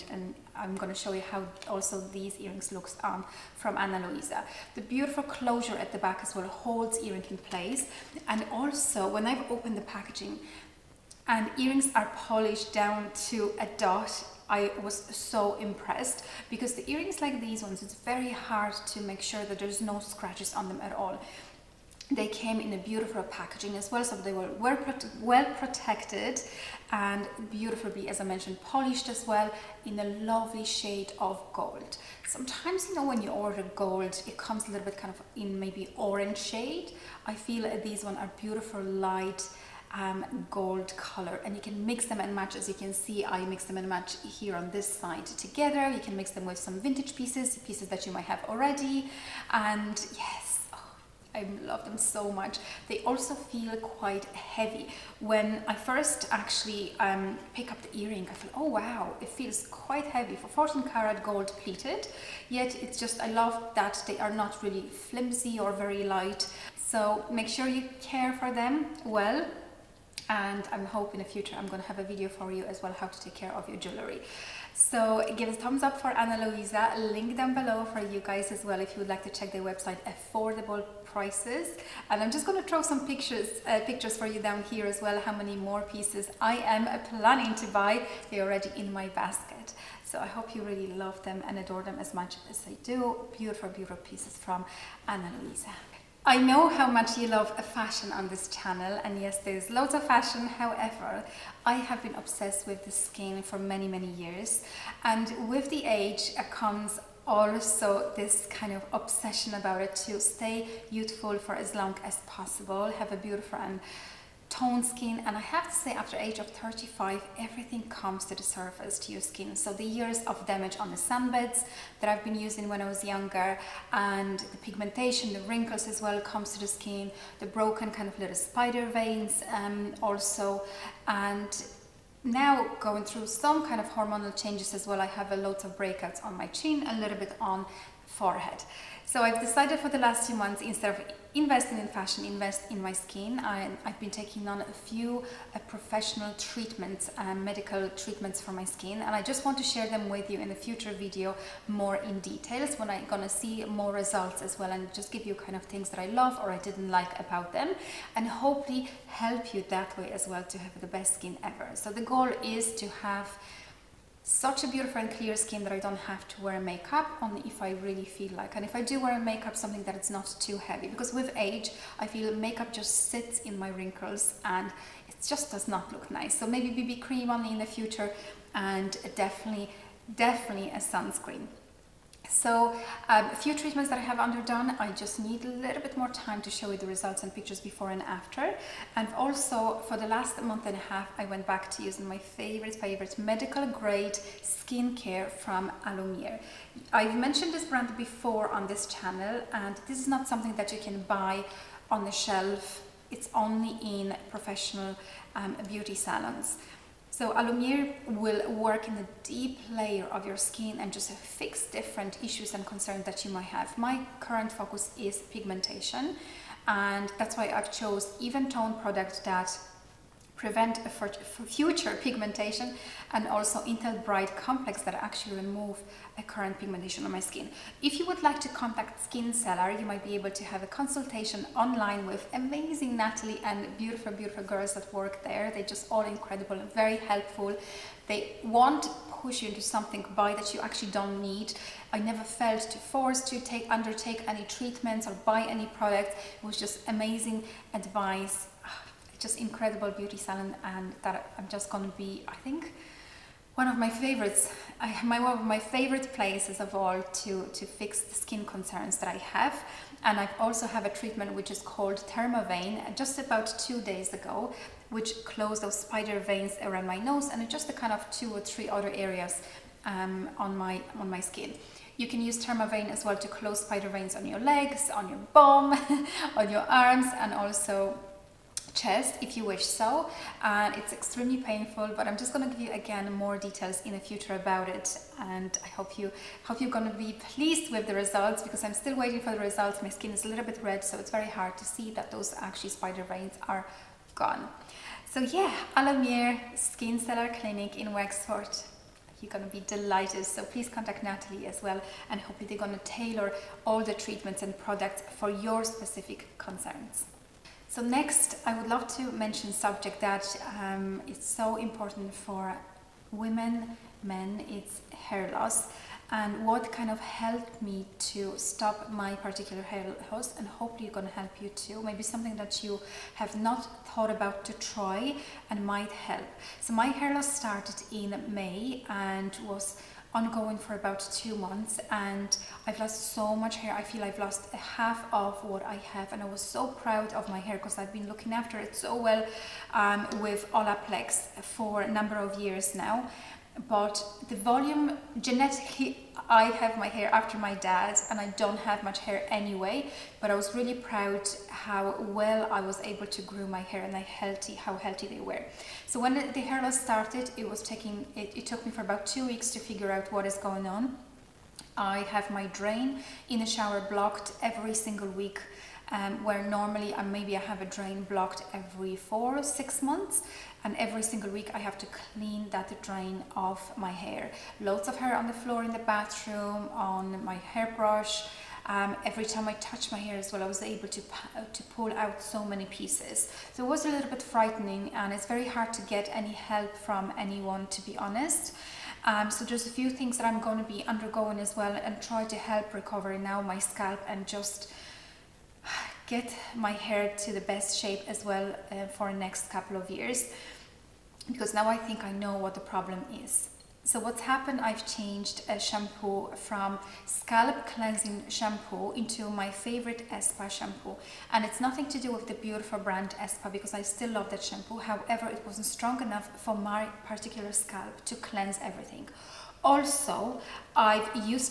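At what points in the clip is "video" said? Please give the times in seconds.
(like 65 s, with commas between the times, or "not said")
72 s, 150 s.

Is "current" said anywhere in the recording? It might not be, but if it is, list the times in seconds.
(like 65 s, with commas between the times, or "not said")
214 s, 226 s.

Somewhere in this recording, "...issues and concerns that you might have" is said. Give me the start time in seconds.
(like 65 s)
212 s.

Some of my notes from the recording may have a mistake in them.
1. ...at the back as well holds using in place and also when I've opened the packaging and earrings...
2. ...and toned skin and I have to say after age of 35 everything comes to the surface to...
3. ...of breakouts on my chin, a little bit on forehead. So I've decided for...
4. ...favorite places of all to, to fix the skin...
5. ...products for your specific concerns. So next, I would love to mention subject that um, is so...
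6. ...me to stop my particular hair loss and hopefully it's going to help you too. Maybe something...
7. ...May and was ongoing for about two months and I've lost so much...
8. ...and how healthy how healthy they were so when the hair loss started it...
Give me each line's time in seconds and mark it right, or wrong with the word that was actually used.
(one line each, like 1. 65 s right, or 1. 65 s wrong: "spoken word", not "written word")
1. 5 s wrong: "earring", not "using"
2. 113 s right
3. 135 s right
4. 255 s right
5. 304 s right
6. 317 s right
7. 328 s right
8. 353 s right.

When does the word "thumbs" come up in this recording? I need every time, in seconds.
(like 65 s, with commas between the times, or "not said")
75 s.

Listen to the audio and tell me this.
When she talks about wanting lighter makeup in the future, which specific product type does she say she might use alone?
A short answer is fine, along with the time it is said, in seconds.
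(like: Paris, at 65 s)
BB cream, at 176 s.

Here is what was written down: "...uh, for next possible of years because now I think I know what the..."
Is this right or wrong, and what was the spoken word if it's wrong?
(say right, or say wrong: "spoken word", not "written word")
wrong: "couple", not "possible".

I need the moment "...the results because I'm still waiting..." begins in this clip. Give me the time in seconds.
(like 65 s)
287 s.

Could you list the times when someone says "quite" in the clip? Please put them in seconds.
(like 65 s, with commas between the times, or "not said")
53 s, 59 s.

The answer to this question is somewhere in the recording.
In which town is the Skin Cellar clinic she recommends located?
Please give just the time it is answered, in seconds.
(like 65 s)
297 s.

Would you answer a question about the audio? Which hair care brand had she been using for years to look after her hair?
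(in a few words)
Olaplex.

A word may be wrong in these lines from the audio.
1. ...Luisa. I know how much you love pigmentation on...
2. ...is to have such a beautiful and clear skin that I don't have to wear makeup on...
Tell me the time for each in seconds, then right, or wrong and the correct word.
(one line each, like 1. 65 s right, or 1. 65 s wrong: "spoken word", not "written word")
1. 95 s wrong: "fashion", not "pigmentation"
2. 162 s right.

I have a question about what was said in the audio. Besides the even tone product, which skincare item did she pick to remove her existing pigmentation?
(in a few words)
IntelliBright Complex.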